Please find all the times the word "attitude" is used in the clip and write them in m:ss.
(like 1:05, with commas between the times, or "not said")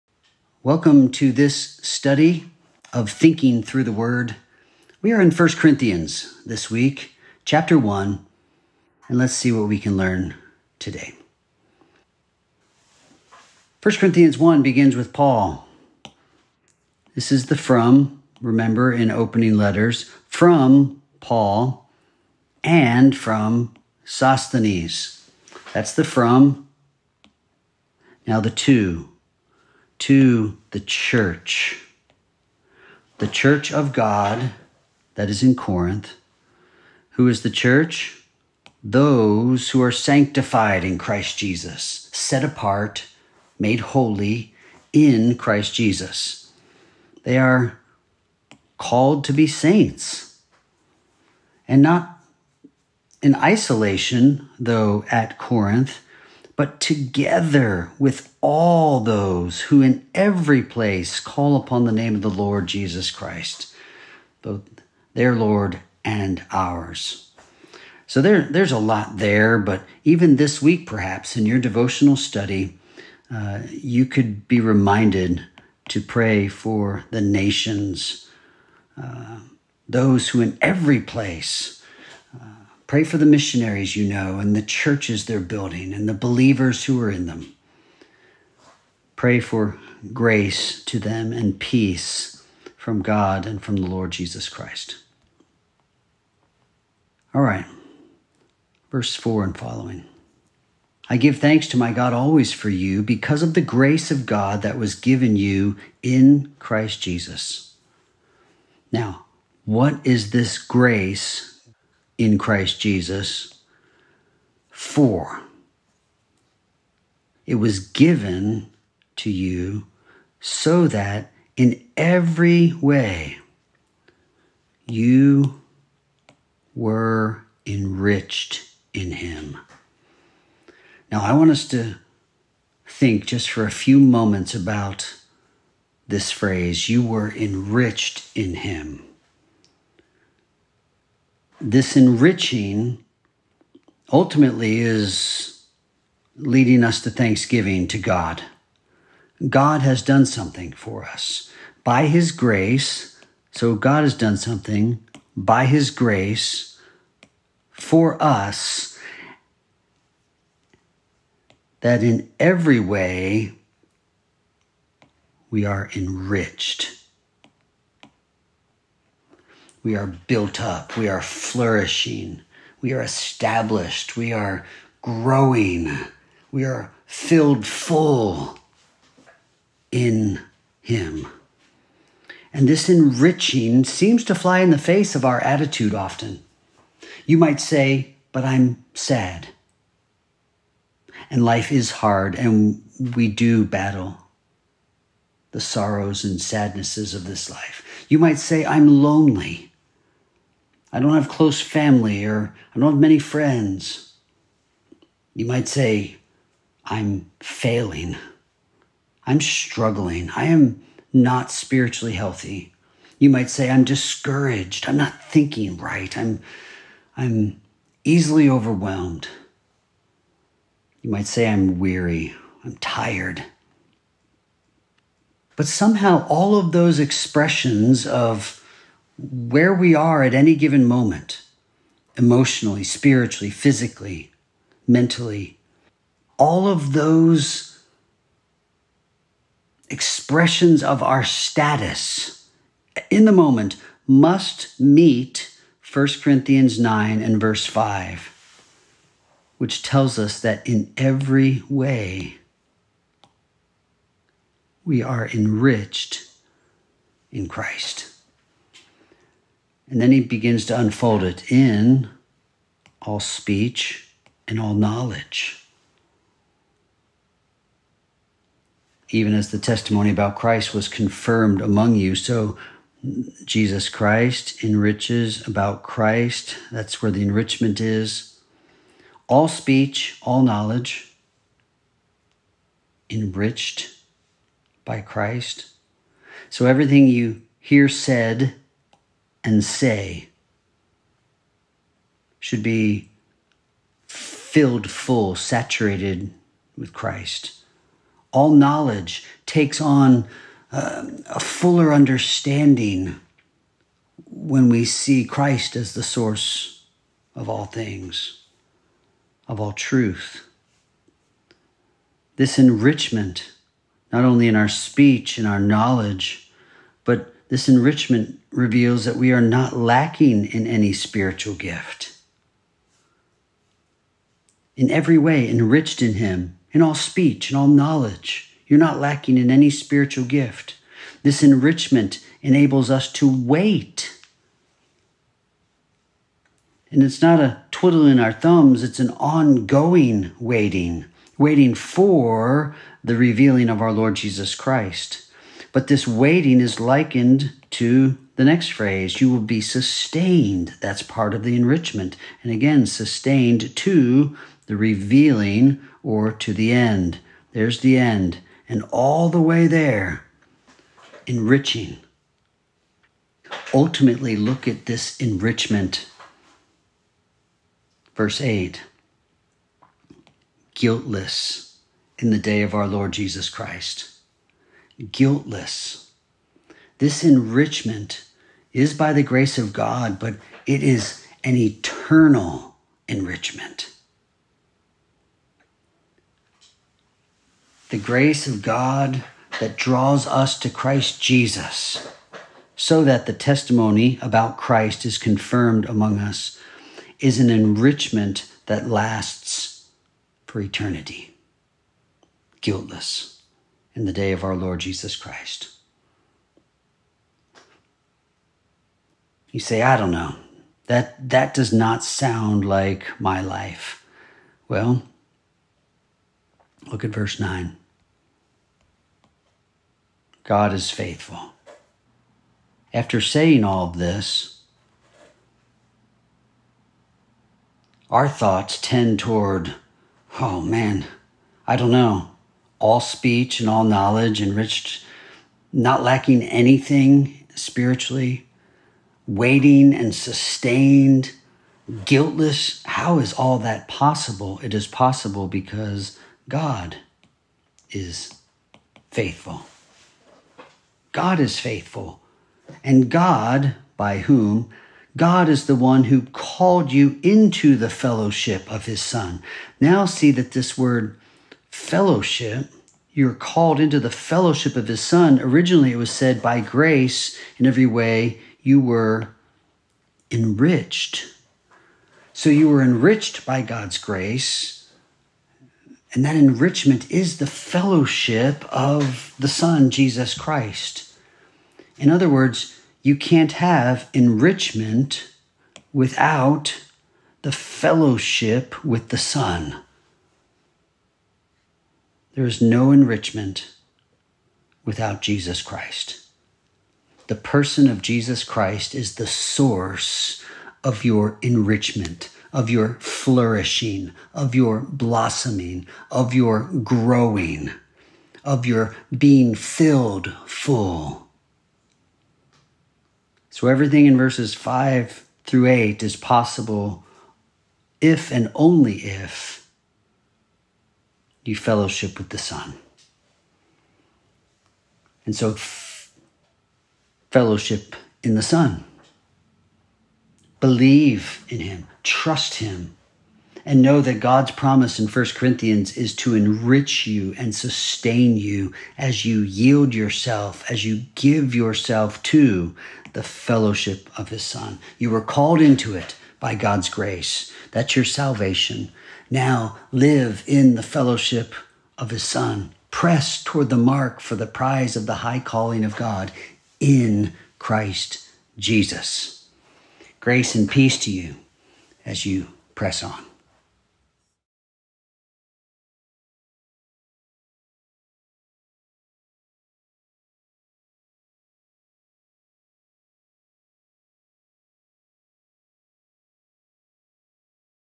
3:05.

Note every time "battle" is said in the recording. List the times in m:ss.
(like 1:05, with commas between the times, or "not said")
3:13.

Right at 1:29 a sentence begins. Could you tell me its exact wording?
Pray for grace to them and peace from God and from the Lord Jesus Christ.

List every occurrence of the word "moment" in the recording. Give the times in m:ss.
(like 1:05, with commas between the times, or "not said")
2:13, 3:50, 4:03.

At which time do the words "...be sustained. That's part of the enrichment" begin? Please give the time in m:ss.
5:49.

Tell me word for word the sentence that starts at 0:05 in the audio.
We are in 1 Corinthians this week, chapter 1, and let's see what we can learn today.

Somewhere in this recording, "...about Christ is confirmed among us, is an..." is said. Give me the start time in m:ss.
6:34.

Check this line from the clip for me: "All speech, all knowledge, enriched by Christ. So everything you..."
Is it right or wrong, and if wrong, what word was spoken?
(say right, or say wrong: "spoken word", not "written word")
right.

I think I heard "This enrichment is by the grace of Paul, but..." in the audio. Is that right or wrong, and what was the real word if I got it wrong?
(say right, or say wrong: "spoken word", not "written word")
wrong: "God", not "Paul".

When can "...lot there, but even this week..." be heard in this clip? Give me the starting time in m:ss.
1:08.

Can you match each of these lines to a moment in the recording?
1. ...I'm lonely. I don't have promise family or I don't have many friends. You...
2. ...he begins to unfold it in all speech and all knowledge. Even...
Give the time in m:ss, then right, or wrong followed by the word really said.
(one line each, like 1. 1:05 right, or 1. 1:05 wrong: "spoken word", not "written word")
1. 3:18 wrong: "close", not "promise"
2. 4:20 right.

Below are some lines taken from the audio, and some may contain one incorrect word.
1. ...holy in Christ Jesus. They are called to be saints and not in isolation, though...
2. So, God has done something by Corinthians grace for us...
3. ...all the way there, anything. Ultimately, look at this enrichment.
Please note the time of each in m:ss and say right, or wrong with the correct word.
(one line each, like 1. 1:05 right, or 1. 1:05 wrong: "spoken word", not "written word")
1. 0:43 right
2. 2:33 wrong: "His", not "Corinthians"
3. 5:58 wrong: "enriching", not "anything".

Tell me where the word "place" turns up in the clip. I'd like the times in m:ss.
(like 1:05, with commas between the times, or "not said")
1:00, 1:20.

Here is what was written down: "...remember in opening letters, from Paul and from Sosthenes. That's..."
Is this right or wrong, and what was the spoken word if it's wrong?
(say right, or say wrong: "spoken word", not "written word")
right.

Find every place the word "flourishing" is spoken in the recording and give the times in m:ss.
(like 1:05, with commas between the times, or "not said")
2:51, 8:23.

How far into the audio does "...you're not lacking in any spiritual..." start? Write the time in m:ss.
5:28.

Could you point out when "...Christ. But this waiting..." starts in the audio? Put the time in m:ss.
5:44.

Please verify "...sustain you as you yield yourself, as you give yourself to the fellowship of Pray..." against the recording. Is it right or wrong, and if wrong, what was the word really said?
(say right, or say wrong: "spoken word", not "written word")
wrong: "His", not "Pray".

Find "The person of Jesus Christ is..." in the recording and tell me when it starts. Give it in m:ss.
8:17.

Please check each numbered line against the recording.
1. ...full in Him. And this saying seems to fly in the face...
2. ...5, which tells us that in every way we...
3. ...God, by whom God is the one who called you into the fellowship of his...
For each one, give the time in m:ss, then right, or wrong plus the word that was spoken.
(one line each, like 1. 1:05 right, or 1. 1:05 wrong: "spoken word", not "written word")
1. 2:57 wrong: "enriching", not "saying"
2. 4:07 right
3. 7:33 right.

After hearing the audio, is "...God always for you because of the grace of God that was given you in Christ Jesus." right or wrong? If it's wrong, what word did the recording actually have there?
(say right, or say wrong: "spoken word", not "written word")
right.